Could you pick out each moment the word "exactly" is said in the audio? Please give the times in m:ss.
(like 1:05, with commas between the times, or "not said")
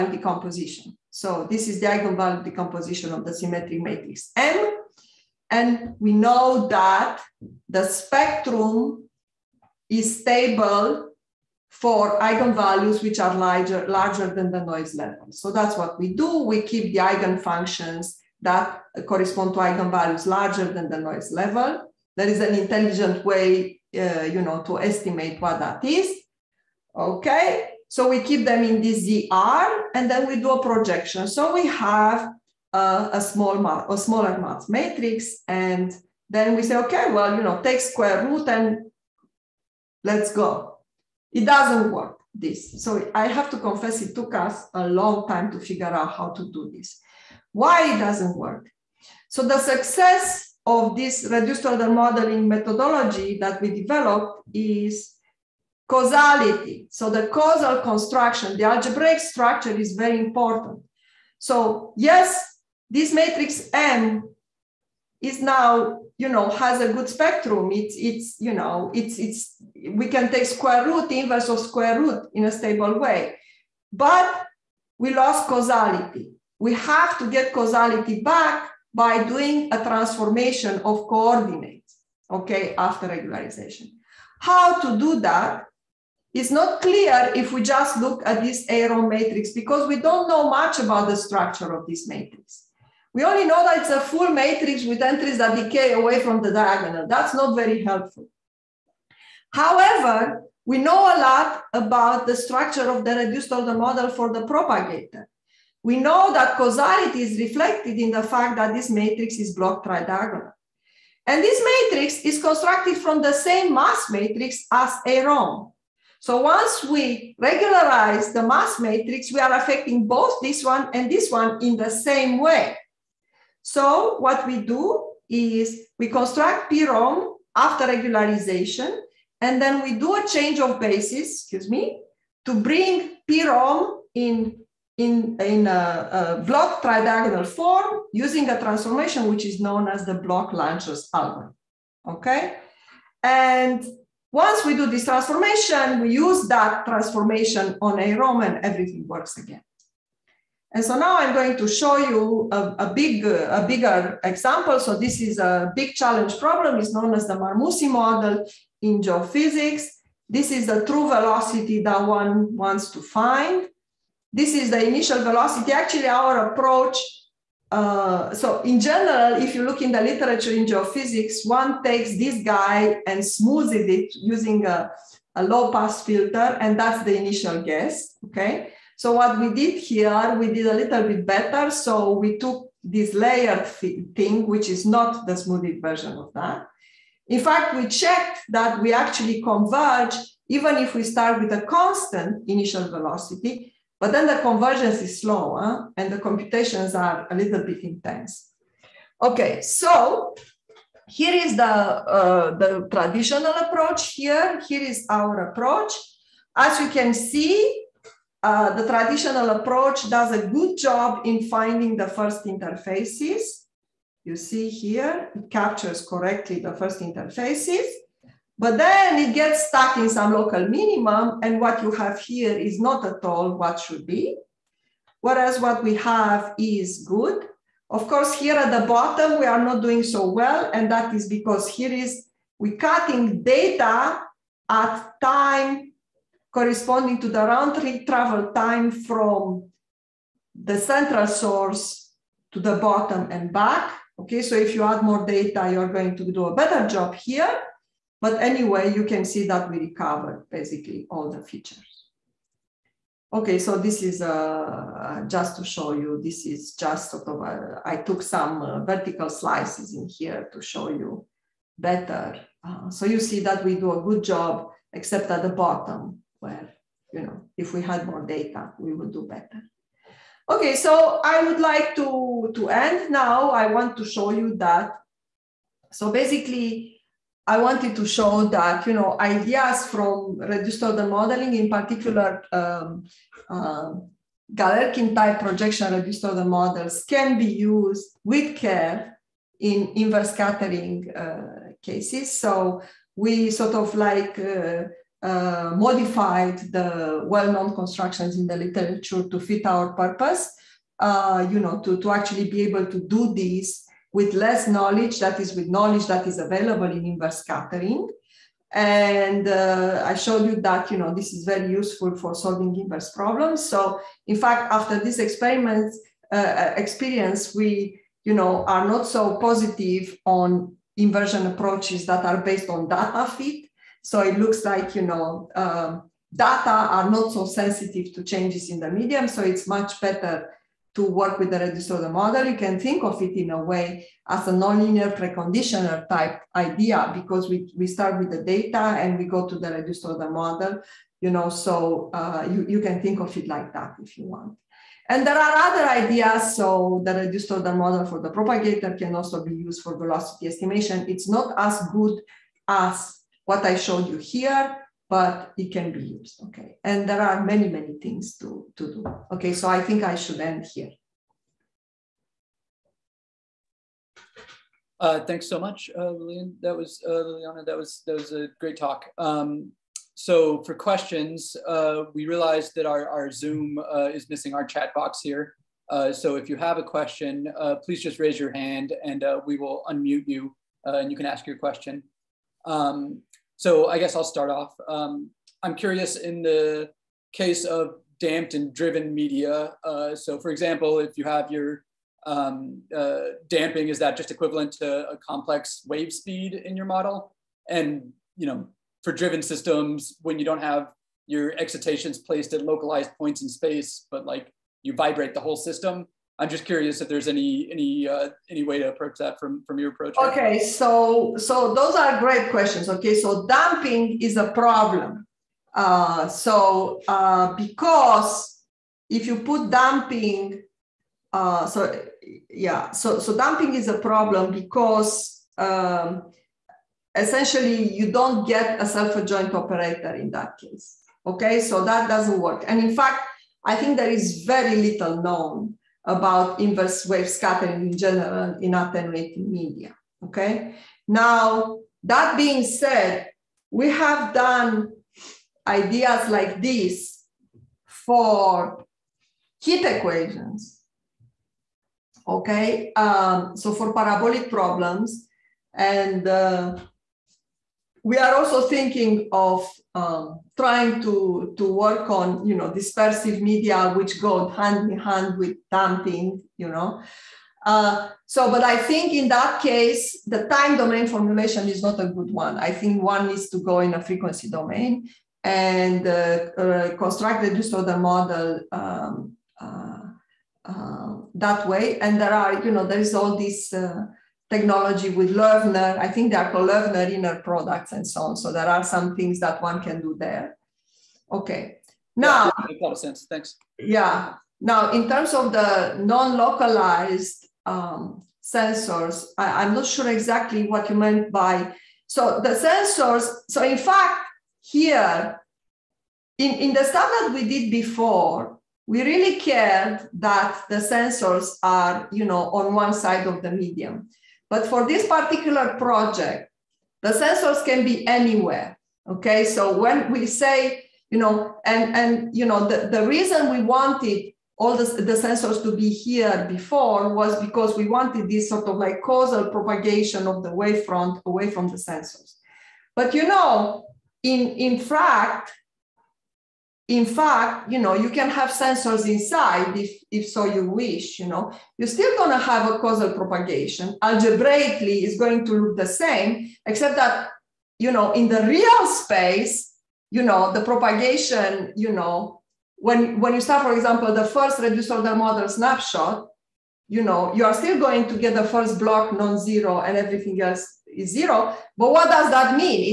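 8:20.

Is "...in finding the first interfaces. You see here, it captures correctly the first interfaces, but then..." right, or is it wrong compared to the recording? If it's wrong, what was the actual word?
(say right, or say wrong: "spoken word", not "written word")
right.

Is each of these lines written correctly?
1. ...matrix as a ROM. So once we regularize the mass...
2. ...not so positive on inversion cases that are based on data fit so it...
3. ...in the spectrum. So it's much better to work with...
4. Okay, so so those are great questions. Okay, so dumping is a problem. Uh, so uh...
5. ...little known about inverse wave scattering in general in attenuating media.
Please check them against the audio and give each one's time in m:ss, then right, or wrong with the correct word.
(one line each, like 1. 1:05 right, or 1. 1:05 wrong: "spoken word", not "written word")
1. 1:54 right
2. 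5:18 wrong: "approaches", not "cases"
3. 5:28 wrong: "medium", not "spectrum"
4. 6:50 right
5. 7:14 right.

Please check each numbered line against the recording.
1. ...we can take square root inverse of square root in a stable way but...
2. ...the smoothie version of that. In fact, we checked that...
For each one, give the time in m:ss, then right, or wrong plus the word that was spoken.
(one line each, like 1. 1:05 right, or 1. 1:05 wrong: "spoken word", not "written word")
1. 1:09 right
2. 3:05 right.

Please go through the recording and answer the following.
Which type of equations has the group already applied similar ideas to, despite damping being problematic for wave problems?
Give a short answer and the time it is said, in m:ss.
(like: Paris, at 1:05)
Heat equations, at 7:29.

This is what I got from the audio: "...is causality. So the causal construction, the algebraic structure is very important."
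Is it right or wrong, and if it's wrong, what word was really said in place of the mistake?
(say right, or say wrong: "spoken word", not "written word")
right.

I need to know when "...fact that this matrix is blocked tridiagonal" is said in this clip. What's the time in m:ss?
1:48.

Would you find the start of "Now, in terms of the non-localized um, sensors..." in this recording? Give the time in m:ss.
8:14.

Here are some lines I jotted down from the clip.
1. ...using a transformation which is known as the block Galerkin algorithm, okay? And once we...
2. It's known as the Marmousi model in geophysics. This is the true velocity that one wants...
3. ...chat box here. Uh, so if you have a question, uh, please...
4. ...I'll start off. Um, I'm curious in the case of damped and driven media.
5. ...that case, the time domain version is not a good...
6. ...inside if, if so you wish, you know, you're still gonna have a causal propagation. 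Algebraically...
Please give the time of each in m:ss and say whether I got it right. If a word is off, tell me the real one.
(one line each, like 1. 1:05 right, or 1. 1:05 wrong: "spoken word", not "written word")
1. 2:18 wrong: "Lanczos", not "Galerkin"
2. 2:36 right
3. 6:14 right
4. 6:24 right
5. 7:49 wrong: "formulation", not "version"
6. 8:59 right.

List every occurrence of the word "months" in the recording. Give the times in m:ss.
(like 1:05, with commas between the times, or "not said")
not said.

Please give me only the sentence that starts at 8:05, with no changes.
I think they are called Learner inner products and so on.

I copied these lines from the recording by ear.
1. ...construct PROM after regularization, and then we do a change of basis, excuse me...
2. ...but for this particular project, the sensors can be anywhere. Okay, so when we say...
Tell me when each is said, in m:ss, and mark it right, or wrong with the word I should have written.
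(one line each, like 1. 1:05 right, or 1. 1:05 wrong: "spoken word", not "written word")
1. 2:06 right
2. 8:34 right.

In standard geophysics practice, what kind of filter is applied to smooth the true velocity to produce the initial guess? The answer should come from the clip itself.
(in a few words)
Low pass filter.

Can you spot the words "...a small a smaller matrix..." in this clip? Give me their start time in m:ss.
0:32.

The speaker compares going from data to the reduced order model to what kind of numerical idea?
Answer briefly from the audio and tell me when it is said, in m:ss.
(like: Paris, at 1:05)
Nonlinear preconditioner, at 5:34.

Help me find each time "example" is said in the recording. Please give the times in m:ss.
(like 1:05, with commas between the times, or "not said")
2:34, 6:30, 9:13.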